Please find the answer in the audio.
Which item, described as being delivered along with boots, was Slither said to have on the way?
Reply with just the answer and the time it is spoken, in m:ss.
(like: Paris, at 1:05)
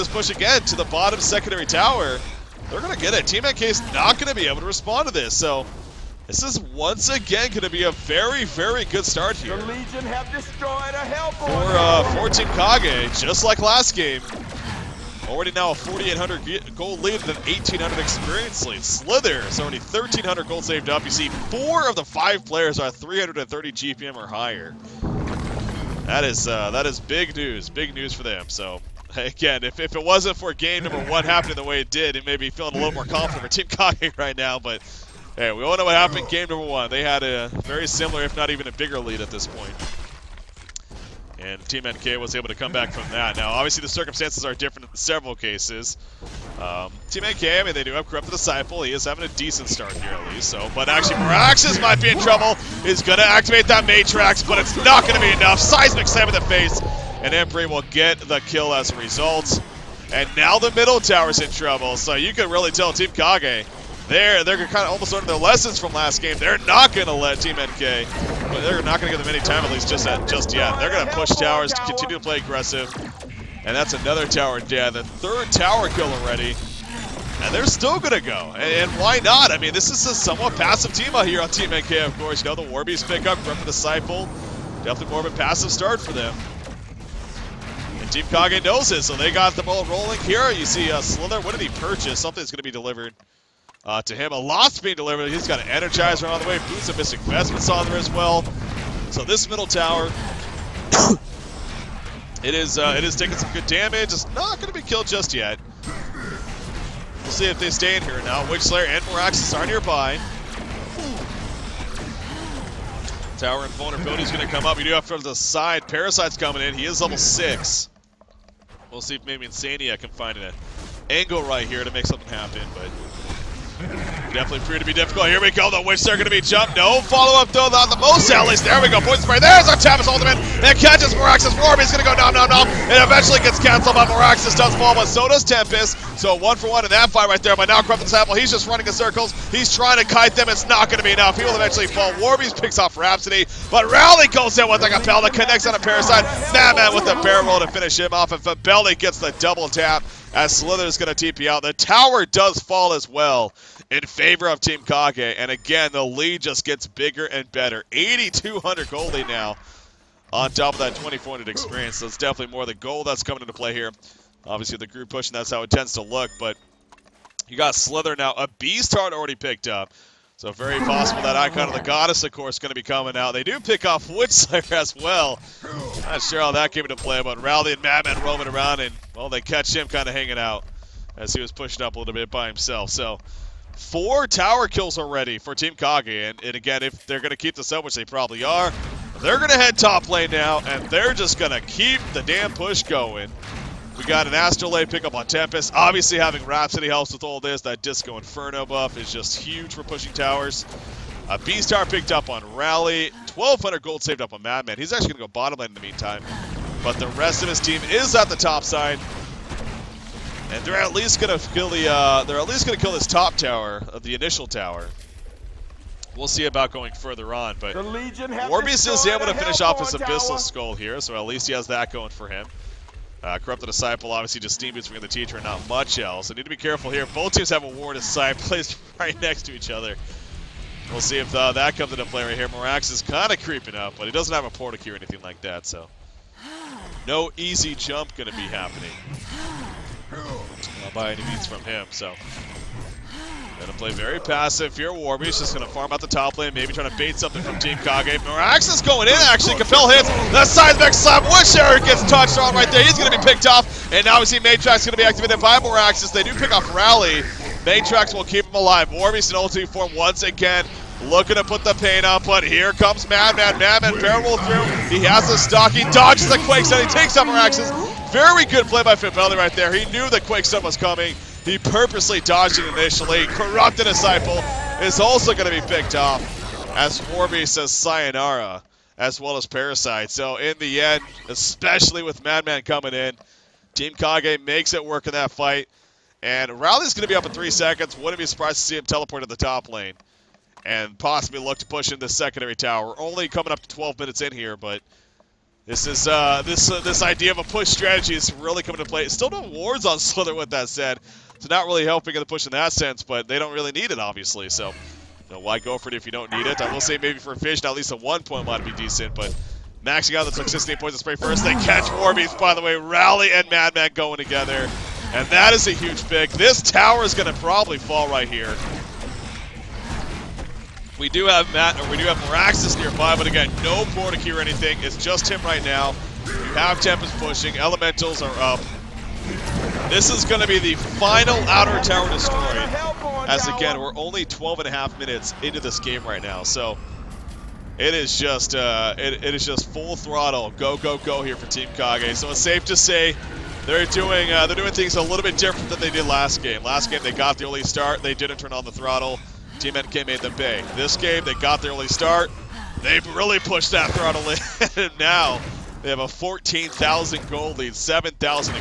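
Energizer, at 1:35.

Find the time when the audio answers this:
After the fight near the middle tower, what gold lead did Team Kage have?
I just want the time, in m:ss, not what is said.
2:37.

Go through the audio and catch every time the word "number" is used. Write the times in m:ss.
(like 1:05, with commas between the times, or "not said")
0:30, 0:36.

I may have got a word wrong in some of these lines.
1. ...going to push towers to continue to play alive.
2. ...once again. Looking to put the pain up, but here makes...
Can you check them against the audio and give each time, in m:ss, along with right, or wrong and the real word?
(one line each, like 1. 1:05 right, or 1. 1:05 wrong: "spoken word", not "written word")
1. 1:10 wrong: "aggressive", not "alive"
2. 4:19 wrong: "comes", not "makes".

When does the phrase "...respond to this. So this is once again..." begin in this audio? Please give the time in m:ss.
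0:04.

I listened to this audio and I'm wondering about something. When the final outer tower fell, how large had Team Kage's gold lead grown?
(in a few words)
14,000.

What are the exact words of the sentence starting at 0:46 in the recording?
Um, Team NK, I mean, they do have corrupted the Disciple.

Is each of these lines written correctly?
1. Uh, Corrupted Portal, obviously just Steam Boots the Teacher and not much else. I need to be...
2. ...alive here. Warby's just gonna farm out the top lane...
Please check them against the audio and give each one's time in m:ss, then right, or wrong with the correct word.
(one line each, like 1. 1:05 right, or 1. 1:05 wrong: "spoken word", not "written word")
1. 3:43 wrong: "Disciple", not "Portal"
2. 4:04 wrong: "passive", not "alive".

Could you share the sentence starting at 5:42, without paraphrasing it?
So it's safe to say they're doing uh, they're doing things a little bit different than they did last game.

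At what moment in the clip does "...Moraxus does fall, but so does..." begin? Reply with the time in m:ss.
2:14.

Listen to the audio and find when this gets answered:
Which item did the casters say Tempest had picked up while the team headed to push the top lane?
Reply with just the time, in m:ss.
3:14.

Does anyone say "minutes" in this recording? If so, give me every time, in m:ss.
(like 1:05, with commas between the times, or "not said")
4:53, 5:34.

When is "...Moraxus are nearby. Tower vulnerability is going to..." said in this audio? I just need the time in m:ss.
1:49.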